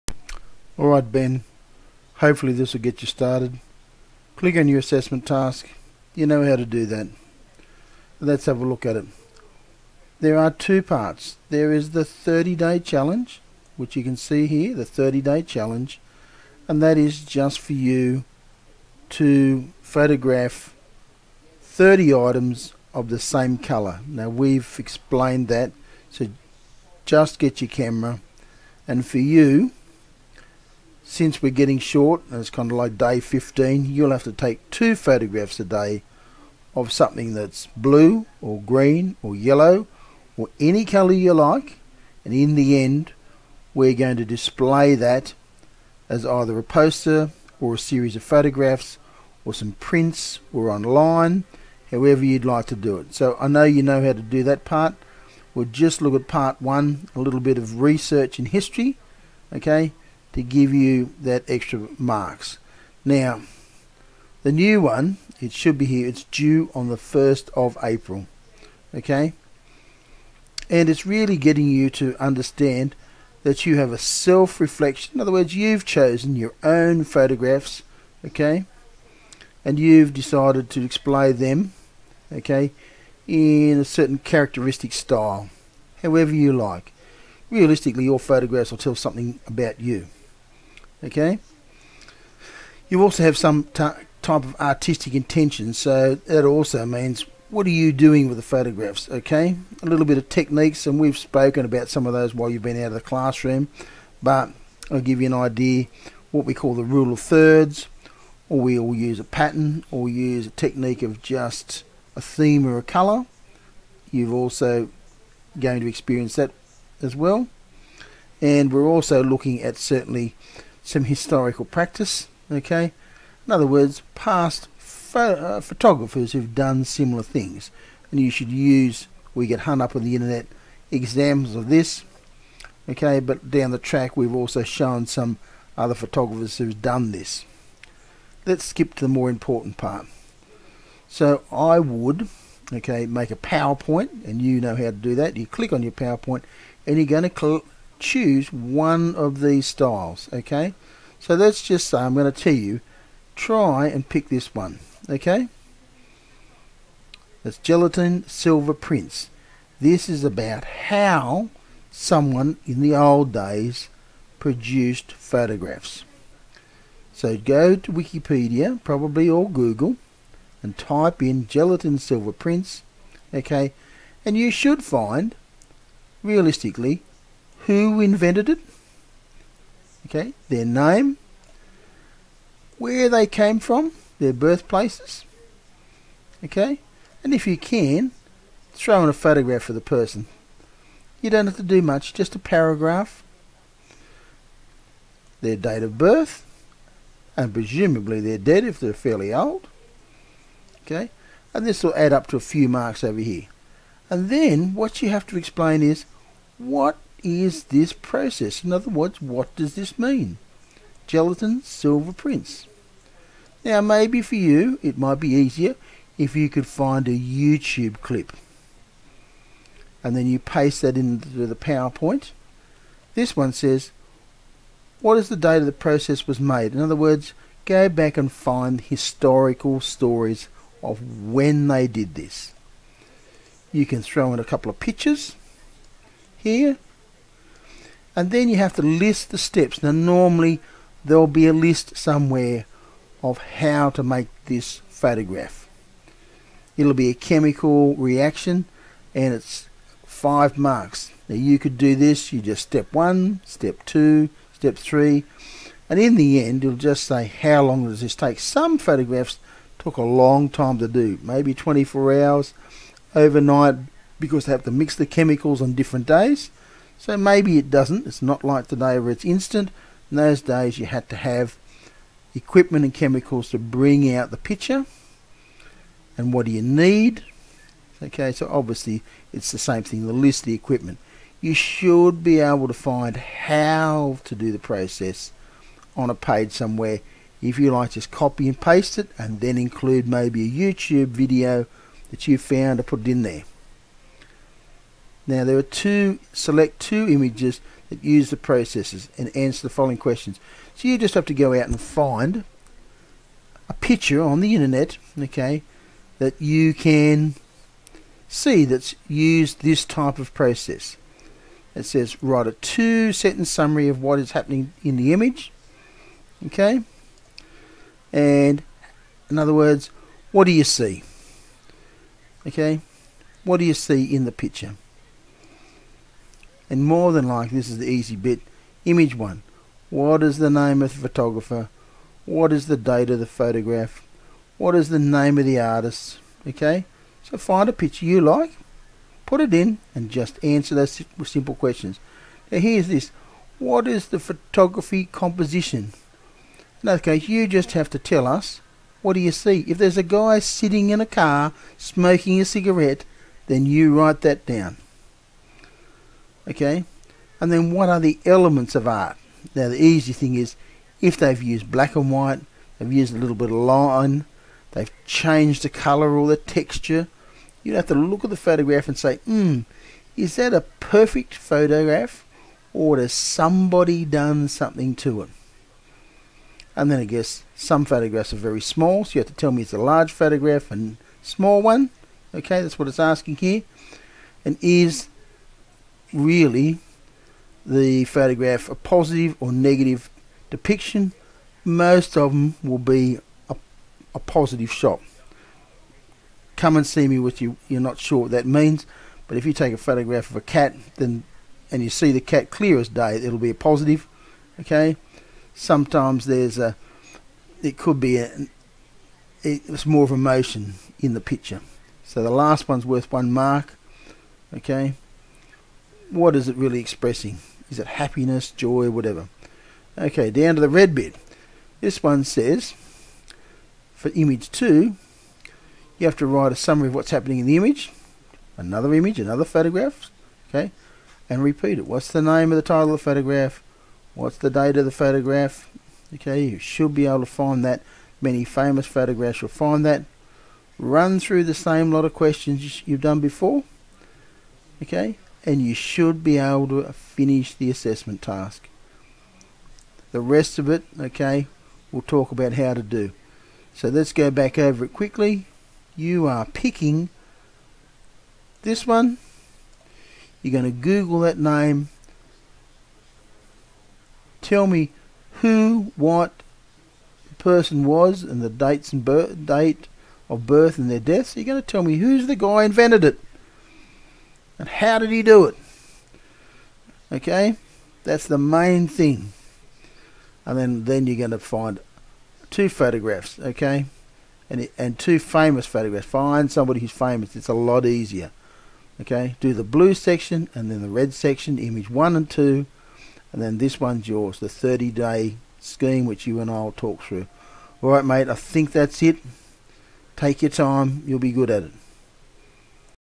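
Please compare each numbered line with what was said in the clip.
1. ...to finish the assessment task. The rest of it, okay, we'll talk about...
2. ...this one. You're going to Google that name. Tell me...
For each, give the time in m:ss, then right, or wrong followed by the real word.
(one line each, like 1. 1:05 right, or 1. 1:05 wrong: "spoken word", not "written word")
1. 7:26 right
2. 7:38 right.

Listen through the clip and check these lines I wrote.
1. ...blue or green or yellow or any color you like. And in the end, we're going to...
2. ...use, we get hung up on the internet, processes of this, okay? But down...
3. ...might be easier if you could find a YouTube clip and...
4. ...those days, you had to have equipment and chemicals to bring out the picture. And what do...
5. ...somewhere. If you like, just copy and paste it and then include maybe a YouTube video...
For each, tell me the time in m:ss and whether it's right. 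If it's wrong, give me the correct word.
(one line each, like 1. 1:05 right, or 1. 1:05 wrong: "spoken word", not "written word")
1. 0:37 right
2. 2:08 wrong: "examples", not "processes"
3. 3:34 right
4. 4:30 right
5. 4:46 right.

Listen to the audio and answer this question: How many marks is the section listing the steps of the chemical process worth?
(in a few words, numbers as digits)
5.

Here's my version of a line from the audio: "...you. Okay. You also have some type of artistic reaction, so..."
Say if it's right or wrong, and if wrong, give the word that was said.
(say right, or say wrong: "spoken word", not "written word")
wrong: "intention", not "reaction".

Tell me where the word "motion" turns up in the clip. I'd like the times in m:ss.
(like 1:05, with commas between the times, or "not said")
6:50.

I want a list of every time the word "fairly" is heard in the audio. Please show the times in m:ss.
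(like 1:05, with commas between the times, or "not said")
3:18.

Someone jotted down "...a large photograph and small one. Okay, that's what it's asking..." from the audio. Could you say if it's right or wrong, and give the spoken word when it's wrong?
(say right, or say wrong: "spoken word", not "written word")
right.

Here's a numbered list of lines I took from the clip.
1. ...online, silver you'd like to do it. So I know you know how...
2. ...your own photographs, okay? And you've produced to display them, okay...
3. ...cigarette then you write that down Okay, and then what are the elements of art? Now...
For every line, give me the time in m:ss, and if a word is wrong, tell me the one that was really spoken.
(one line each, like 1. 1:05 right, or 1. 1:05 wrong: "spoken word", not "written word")
1. 0:50 wrong: "however", not "silver"
2. 1:16 wrong: "decided", not "produced"
3. 5:52 right.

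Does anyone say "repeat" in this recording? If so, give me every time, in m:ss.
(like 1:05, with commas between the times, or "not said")
7:11.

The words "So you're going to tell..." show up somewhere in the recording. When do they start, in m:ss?
7:51.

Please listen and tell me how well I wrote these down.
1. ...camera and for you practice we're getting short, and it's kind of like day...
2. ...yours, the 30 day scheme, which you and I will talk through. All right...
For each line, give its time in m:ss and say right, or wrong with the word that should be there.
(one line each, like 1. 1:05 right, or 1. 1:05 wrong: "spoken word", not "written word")
1. 0:27 wrong: "since", not "practice"
2. 8:14 right.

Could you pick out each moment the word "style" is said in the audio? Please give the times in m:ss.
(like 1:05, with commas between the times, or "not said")
1:24, 2:29.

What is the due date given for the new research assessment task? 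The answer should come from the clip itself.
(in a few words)
1st of April.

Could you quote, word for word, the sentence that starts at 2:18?
Let's skip to the more important part.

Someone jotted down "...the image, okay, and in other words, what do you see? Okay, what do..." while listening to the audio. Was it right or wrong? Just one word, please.
right.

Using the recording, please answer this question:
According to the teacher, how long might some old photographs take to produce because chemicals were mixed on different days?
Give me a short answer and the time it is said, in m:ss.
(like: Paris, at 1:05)
24 hours, at 4:21.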